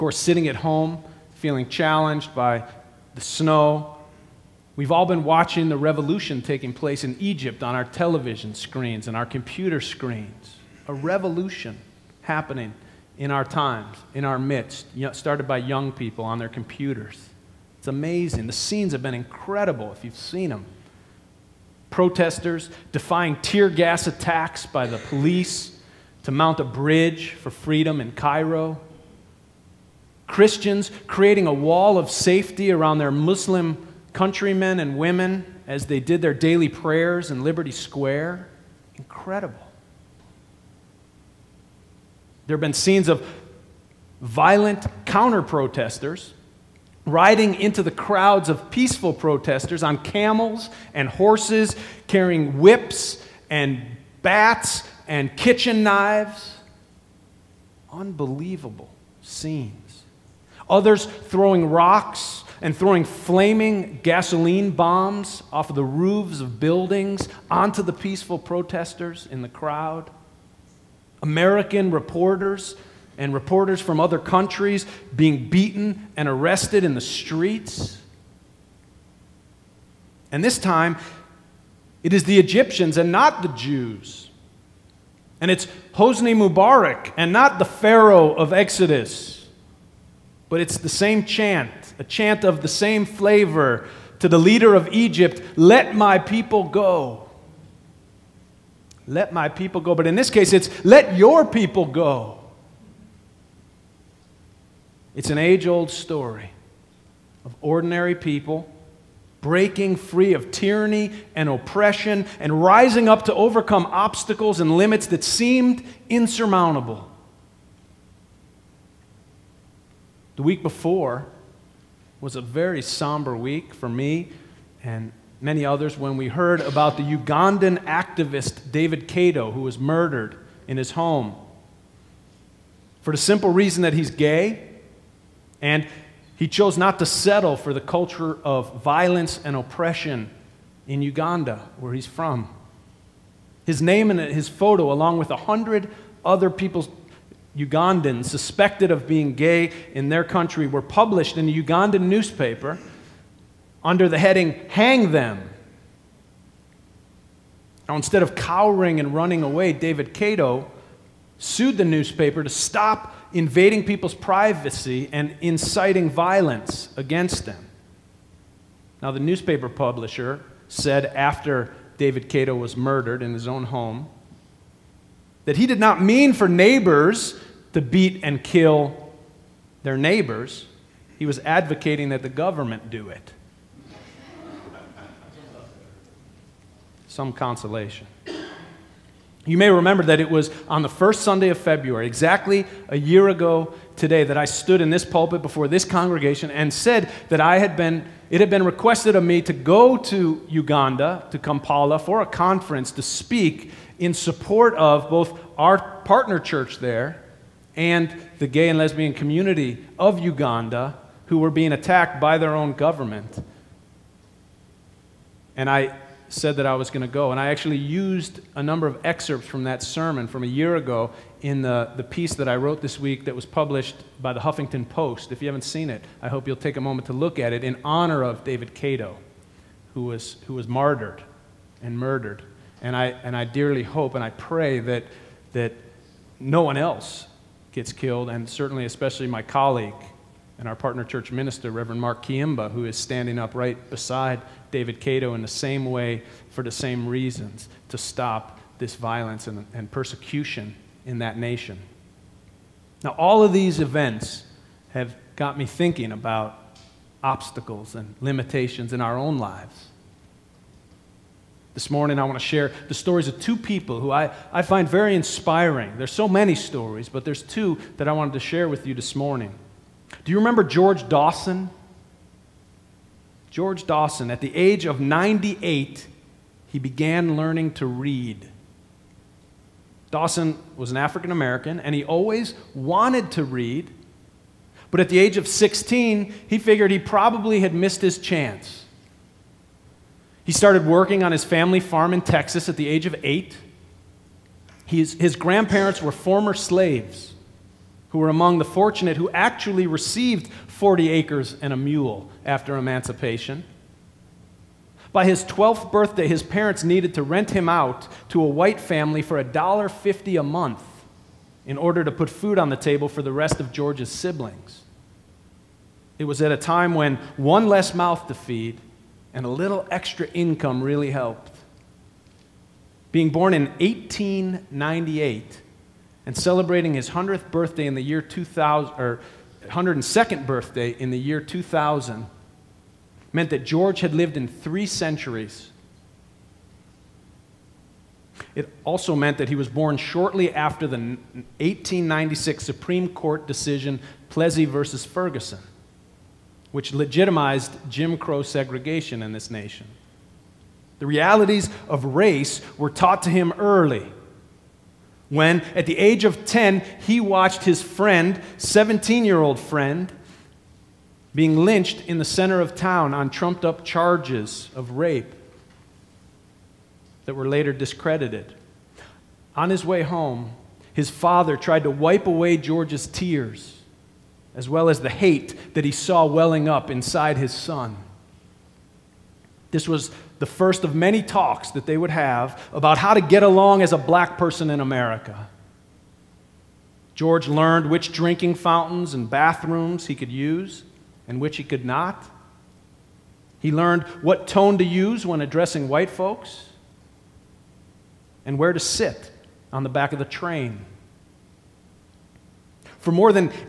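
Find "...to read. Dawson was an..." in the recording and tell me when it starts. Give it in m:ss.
4:37.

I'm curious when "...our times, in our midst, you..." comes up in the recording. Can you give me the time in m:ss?
0:13.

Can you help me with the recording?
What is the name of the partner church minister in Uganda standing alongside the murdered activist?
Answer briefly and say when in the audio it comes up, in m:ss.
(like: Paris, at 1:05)
Mark Kiyimba, at 4:01.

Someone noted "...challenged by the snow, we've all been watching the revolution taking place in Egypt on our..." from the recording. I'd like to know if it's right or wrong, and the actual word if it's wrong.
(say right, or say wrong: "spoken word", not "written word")
right.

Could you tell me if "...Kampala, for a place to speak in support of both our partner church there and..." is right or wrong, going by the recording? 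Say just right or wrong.
wrong.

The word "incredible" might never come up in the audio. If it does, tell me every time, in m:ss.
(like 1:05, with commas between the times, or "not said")
0:19, 0:38.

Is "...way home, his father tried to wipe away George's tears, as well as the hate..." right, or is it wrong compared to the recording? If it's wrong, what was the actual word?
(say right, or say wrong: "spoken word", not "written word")
right.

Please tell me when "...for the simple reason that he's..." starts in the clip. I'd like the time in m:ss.
2:13.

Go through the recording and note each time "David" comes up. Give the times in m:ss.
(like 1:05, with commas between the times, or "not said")
2:08, 2:39, 2:51, 3:48, 4:04.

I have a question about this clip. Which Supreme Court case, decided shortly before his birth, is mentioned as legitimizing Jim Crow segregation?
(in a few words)
Plessy versus Ferguson.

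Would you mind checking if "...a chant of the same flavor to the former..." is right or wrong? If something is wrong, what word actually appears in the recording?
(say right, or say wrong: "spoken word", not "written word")
wrong: "leader", not "former".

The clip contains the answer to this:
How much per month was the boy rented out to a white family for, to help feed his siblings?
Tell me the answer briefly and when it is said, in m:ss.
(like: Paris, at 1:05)
$1.50, at 5:09.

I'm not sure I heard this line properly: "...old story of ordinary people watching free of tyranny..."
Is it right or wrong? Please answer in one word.
wrong.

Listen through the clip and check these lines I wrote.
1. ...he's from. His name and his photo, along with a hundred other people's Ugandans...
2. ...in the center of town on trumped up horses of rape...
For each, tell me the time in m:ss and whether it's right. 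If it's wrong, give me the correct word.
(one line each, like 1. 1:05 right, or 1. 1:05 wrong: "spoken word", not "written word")
1. 2:21 right
2. 6:02 wrong: "charges", not "horses".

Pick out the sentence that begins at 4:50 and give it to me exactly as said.
He started working on his family farm in Texas at the age of eight.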